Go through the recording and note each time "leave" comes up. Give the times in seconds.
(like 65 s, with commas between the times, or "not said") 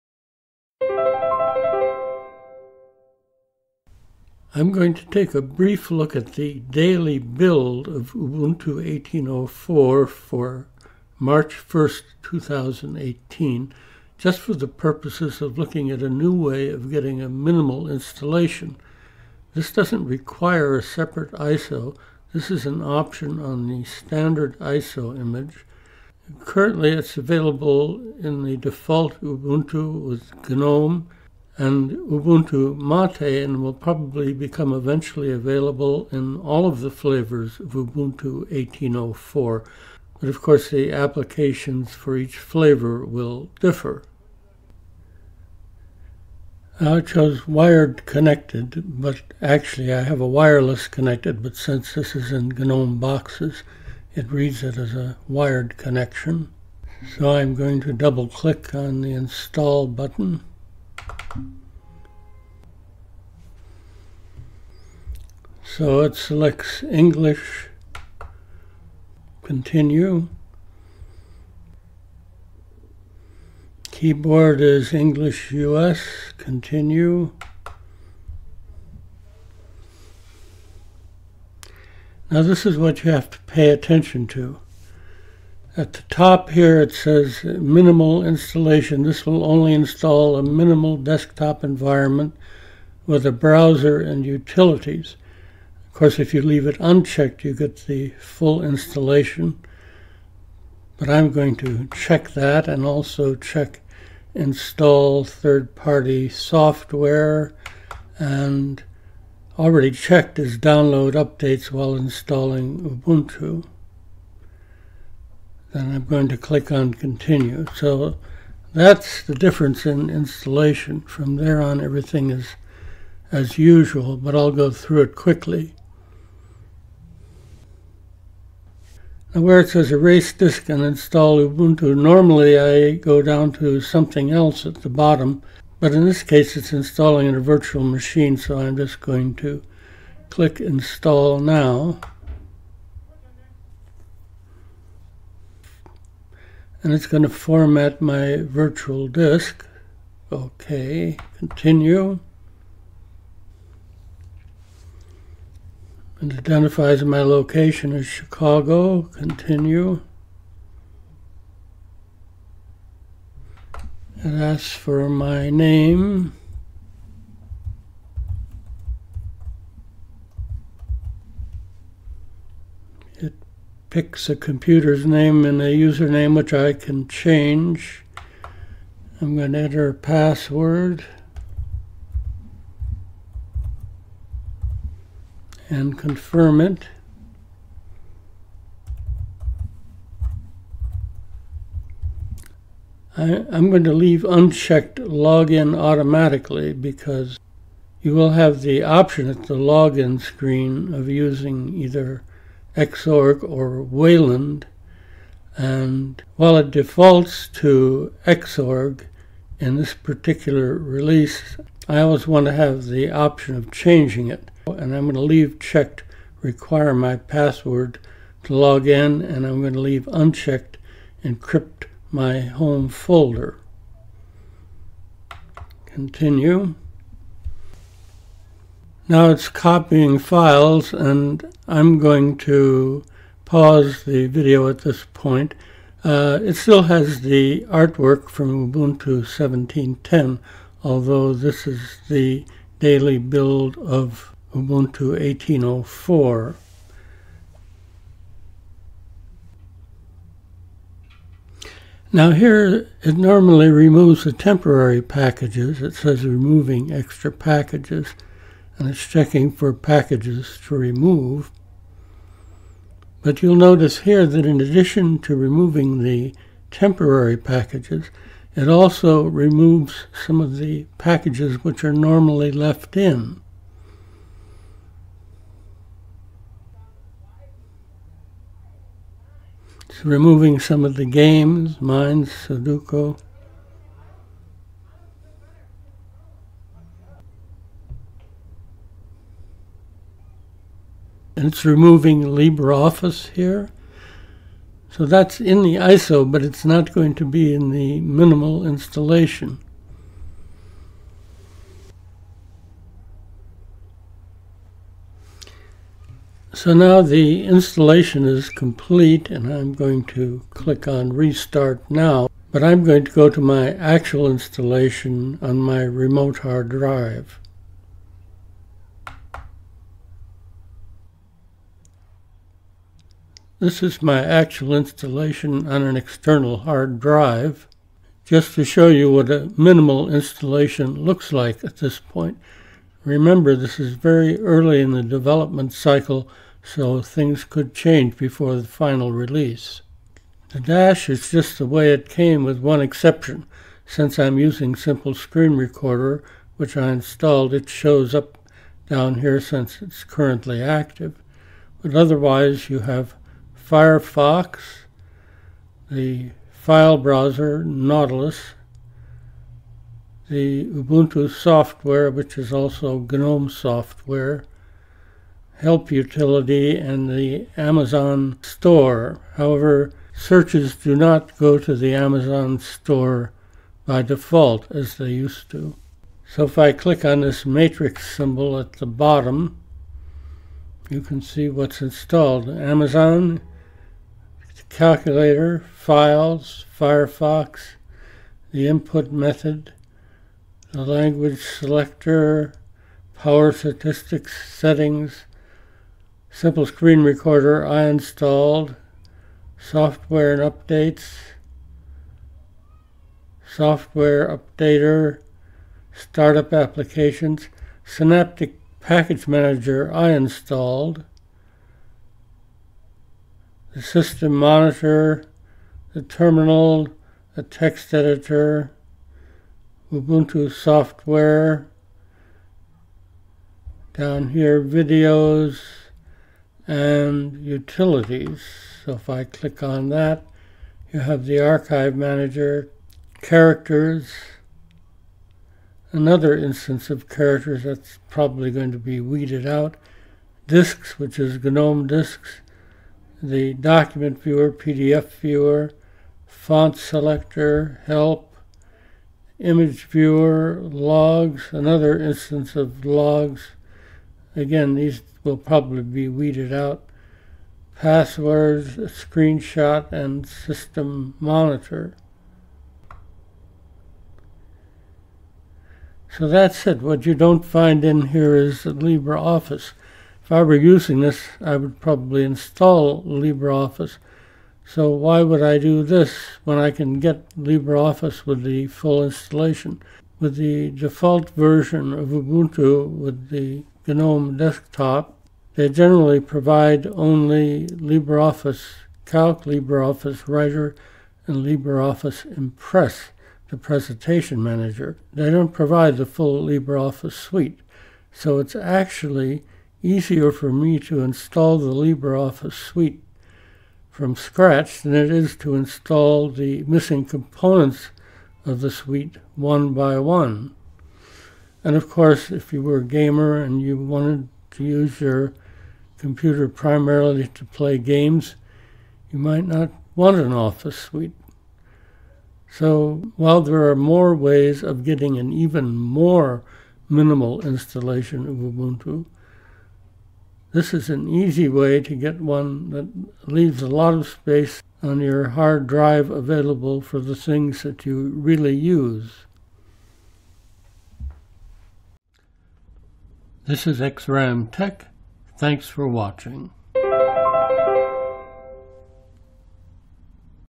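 96 s, 193 s, 215 s, 219 s, 533 s.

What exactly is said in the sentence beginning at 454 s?
Again, these will probably be weeded out.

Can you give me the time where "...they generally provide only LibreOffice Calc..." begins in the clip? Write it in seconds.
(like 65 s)
485 s.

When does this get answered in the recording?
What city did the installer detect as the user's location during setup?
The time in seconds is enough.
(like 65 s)
158 s.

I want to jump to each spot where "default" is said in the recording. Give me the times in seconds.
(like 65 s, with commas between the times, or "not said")
28 s, 206 s, 374 s, 480 s.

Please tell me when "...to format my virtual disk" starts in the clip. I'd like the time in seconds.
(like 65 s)
147 s.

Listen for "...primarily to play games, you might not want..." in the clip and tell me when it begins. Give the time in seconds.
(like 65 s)
516 s.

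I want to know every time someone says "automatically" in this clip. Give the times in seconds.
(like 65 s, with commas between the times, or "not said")
195 s.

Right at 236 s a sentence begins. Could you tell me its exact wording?
Uh, it still has the artwork from Ubuntu 17.10, although this is the daily build of Ubuntu 18.04.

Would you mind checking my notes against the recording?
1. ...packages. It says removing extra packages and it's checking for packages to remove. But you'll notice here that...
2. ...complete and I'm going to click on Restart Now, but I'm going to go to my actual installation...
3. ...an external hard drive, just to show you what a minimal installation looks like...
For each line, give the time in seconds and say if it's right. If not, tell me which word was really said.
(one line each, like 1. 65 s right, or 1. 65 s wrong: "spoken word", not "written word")
1. 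255 s right
2. 308 s right
3. 325 s right.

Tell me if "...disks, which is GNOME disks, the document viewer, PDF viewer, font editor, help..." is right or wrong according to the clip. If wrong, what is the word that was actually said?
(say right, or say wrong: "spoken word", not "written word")
wrong: "selector", not "editor".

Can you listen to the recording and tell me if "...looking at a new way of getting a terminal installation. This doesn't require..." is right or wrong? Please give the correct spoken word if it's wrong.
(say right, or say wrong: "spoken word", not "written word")
wrong: "minimal", not "terminal".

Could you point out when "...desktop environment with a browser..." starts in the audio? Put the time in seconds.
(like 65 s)
90 s.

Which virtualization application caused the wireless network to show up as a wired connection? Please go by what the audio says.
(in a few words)
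GNOME boxes.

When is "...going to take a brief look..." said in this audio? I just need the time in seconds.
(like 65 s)
4 s.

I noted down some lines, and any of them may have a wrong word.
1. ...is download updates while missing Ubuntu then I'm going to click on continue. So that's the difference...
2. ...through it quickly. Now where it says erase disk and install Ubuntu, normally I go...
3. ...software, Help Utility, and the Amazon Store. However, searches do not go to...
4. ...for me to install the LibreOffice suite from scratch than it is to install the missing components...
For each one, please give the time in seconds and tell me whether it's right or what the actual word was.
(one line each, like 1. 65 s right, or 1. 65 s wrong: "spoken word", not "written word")
1. 110 s wrong: "installing", not "missing"
2. 124 s right
3. 363 s right
4. 500 s right.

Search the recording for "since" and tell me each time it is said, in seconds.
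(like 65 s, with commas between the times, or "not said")
51 s, 343 s, 349 s.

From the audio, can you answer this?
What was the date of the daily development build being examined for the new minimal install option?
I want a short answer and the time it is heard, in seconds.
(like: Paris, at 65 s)
March 1st, 2018, at 11 s.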